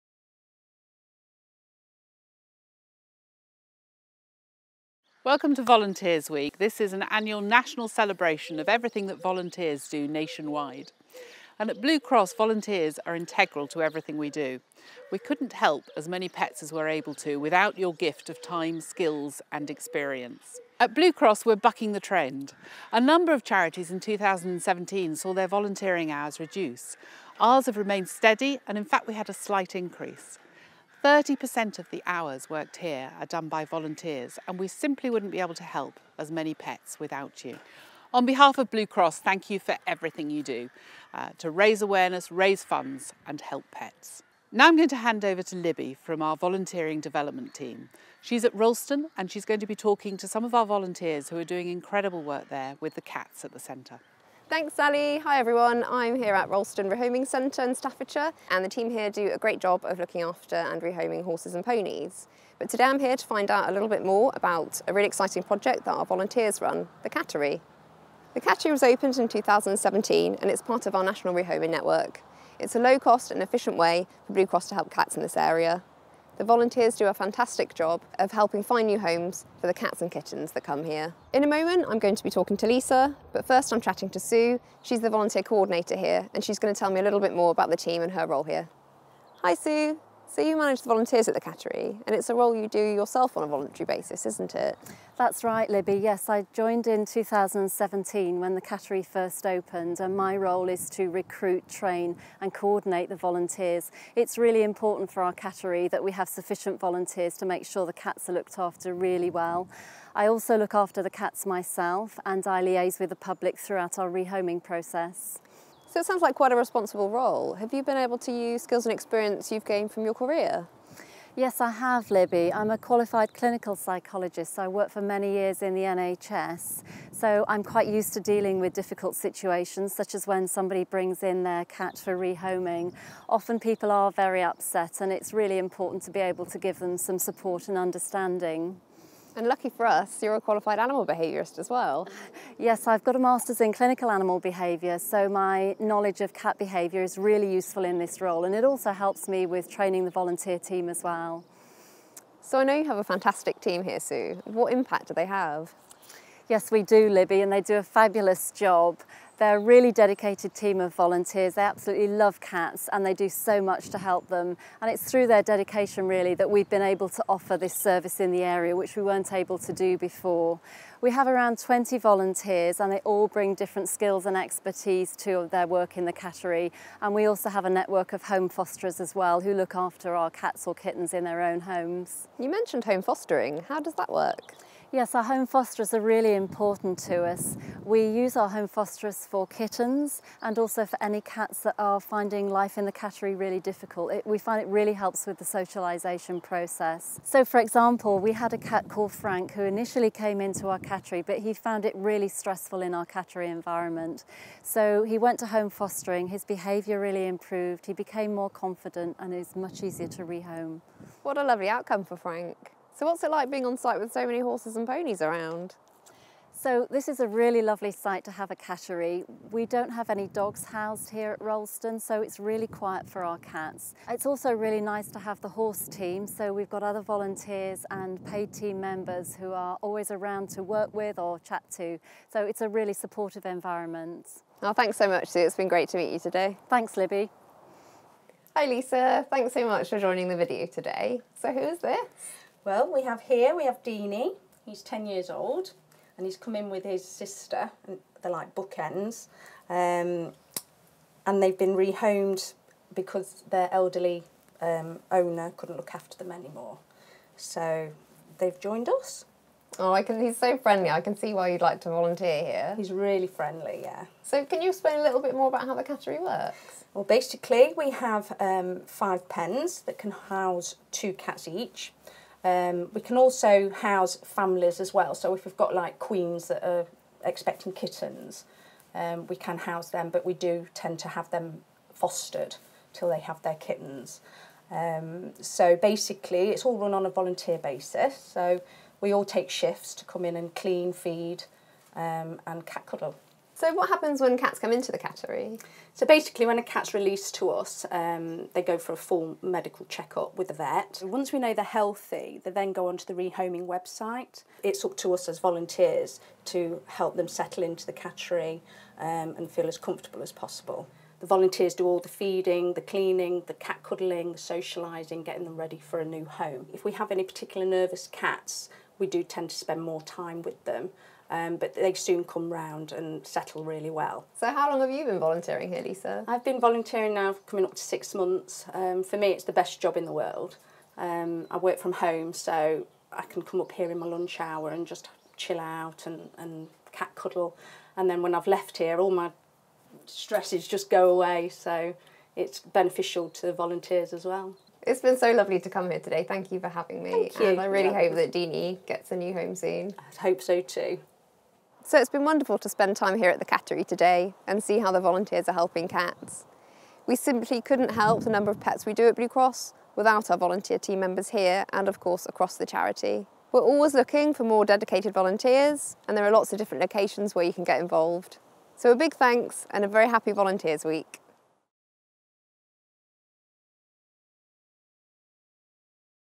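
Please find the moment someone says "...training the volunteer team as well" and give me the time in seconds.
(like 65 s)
149 s.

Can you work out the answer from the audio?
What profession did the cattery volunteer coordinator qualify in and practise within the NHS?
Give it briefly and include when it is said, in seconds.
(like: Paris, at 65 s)
Clinical psychologist, at 123 s.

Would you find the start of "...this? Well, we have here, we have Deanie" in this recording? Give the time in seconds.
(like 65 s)
241 s.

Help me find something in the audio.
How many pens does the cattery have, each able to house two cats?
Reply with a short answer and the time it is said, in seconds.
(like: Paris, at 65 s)
5, at 268 s.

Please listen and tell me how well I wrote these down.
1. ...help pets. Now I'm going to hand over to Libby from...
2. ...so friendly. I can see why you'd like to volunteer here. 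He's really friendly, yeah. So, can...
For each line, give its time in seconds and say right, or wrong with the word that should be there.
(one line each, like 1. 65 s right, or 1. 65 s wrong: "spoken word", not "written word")
1. 43 s right
2. 260 s right.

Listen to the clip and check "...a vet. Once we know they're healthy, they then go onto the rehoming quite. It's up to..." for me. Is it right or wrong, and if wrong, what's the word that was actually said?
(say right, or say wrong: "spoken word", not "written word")
wrong: "website", not "quite".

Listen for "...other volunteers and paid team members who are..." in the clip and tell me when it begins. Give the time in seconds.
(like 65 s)
226 s.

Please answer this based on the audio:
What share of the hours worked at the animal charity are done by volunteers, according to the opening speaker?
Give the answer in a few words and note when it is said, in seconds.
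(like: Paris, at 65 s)
30%, at 31 s.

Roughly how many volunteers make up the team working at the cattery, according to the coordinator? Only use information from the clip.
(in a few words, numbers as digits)
20.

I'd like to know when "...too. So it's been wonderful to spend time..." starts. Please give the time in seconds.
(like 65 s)
350 s.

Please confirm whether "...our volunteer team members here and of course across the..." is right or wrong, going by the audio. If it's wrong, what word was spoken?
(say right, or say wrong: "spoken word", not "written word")
right.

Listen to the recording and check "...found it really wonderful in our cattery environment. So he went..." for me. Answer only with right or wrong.
wrong.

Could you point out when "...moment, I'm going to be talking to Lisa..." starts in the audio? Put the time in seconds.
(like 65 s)
81 s.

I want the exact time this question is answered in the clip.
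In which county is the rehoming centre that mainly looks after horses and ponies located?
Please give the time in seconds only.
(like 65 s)
57 s.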